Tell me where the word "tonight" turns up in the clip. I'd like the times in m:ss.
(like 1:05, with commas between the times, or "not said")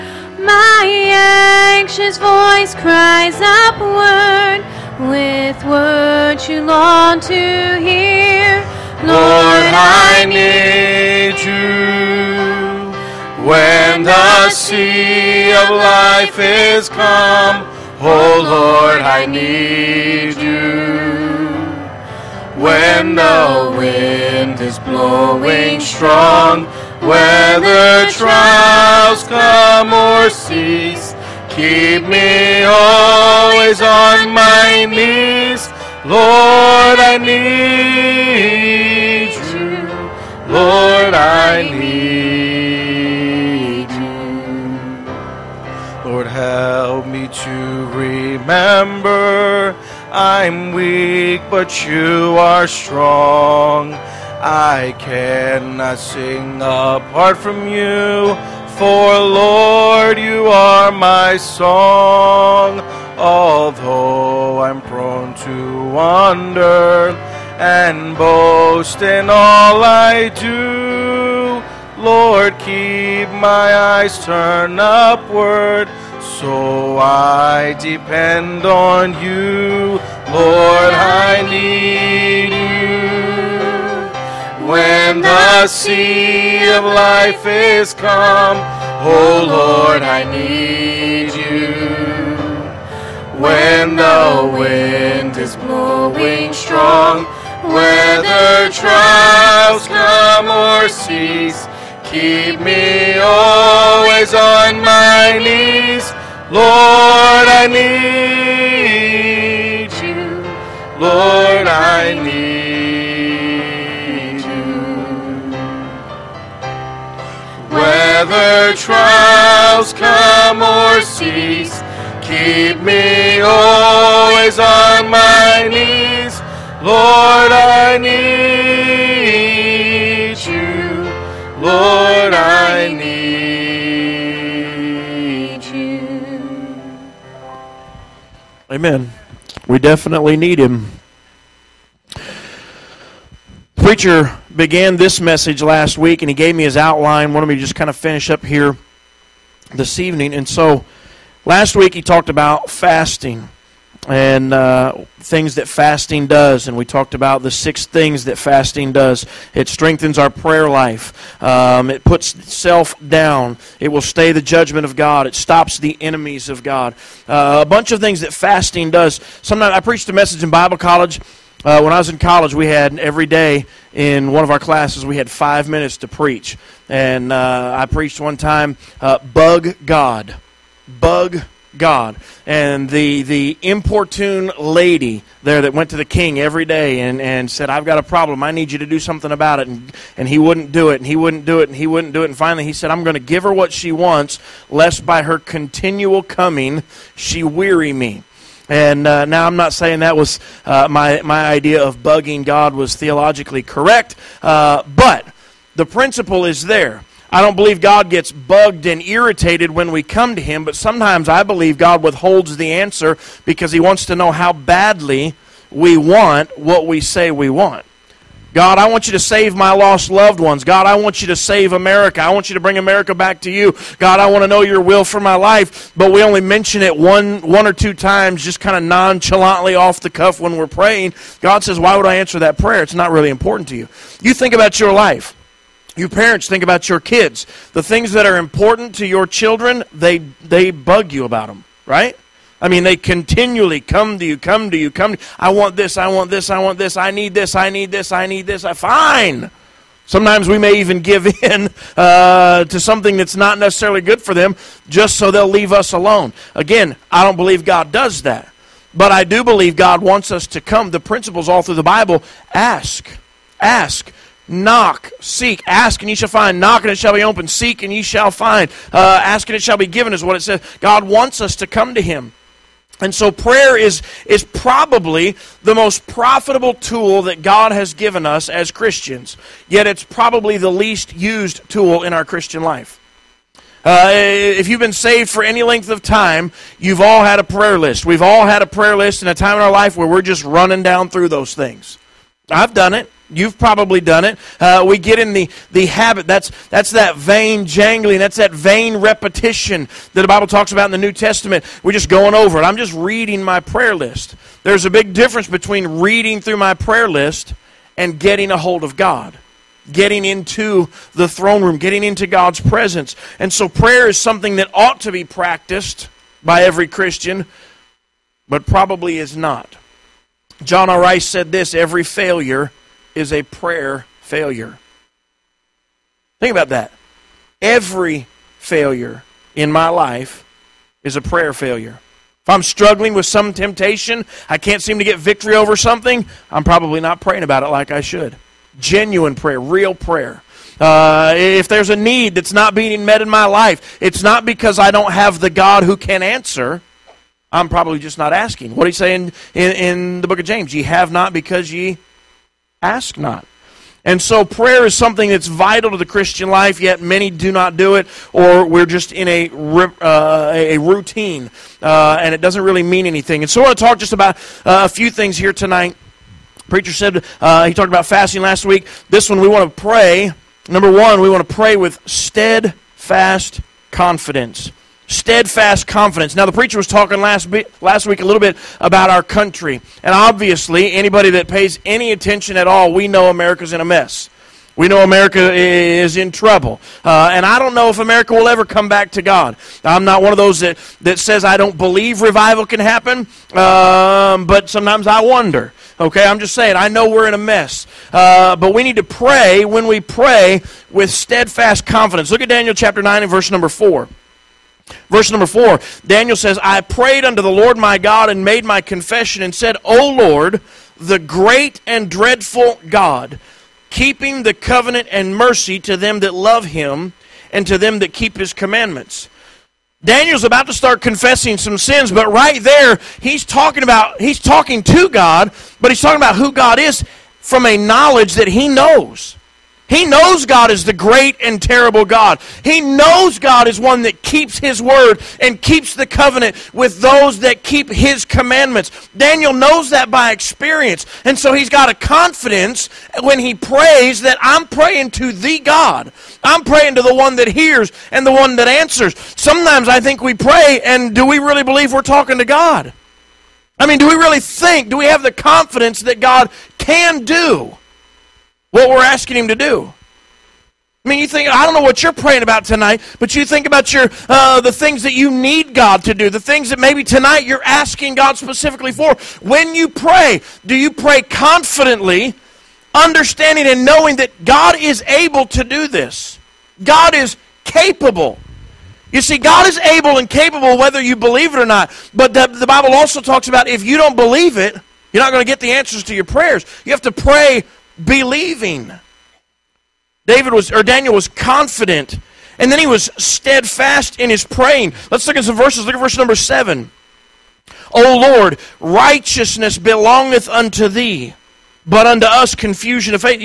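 6:05, 7:42, 7:47.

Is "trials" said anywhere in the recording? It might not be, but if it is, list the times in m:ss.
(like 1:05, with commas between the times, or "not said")
0:28, 1:38, 1:58.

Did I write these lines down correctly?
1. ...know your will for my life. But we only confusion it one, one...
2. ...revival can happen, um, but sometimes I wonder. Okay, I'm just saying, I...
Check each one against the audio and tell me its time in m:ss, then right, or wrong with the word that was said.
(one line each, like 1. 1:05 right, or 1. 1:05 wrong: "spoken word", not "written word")
1. 3:44 wrong: "mention", not "confusion"
2. 6:32 right.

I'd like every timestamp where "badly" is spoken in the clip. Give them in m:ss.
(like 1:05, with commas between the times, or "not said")
3:34.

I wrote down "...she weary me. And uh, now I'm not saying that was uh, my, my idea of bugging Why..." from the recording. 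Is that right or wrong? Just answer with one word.
wrong.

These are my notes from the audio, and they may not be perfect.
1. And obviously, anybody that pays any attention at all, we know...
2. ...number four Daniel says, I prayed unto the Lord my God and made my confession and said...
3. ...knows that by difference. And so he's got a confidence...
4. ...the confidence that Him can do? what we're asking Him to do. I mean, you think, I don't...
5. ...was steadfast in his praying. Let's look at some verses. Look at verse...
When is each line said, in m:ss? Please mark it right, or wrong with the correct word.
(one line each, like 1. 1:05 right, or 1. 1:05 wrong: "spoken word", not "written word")
1. 6:20 right
2. 6:45 right
3. 7:19 wrong: "experience", not "difference"
4. 7:35 wrong: "God", not "Him"
5. 8:12 right.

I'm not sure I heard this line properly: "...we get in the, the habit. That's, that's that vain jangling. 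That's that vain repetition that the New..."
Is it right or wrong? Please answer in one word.
wrong.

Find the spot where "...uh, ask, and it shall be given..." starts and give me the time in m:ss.
4:28.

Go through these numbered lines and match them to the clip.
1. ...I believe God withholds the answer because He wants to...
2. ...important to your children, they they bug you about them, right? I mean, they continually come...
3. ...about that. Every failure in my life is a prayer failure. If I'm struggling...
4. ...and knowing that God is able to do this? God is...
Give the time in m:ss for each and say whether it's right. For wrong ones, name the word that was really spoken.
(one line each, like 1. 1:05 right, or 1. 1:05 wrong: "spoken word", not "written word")
1. 3:31 right
2. 3:58 right
3. 5:26 right
4. 7:53 right.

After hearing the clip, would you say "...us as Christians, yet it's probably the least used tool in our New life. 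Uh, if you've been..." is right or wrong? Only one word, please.
wrong.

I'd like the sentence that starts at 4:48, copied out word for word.
We've all had a prayer list in a time in our life where we're just running down through those things.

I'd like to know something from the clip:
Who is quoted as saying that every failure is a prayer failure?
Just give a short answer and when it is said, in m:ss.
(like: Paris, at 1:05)
John R. Rice, at 5:20.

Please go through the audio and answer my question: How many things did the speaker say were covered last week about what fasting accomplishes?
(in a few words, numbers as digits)
6.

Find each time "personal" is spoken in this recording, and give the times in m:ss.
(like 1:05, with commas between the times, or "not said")
not said.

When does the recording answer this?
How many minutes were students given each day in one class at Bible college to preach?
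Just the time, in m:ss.
2:55.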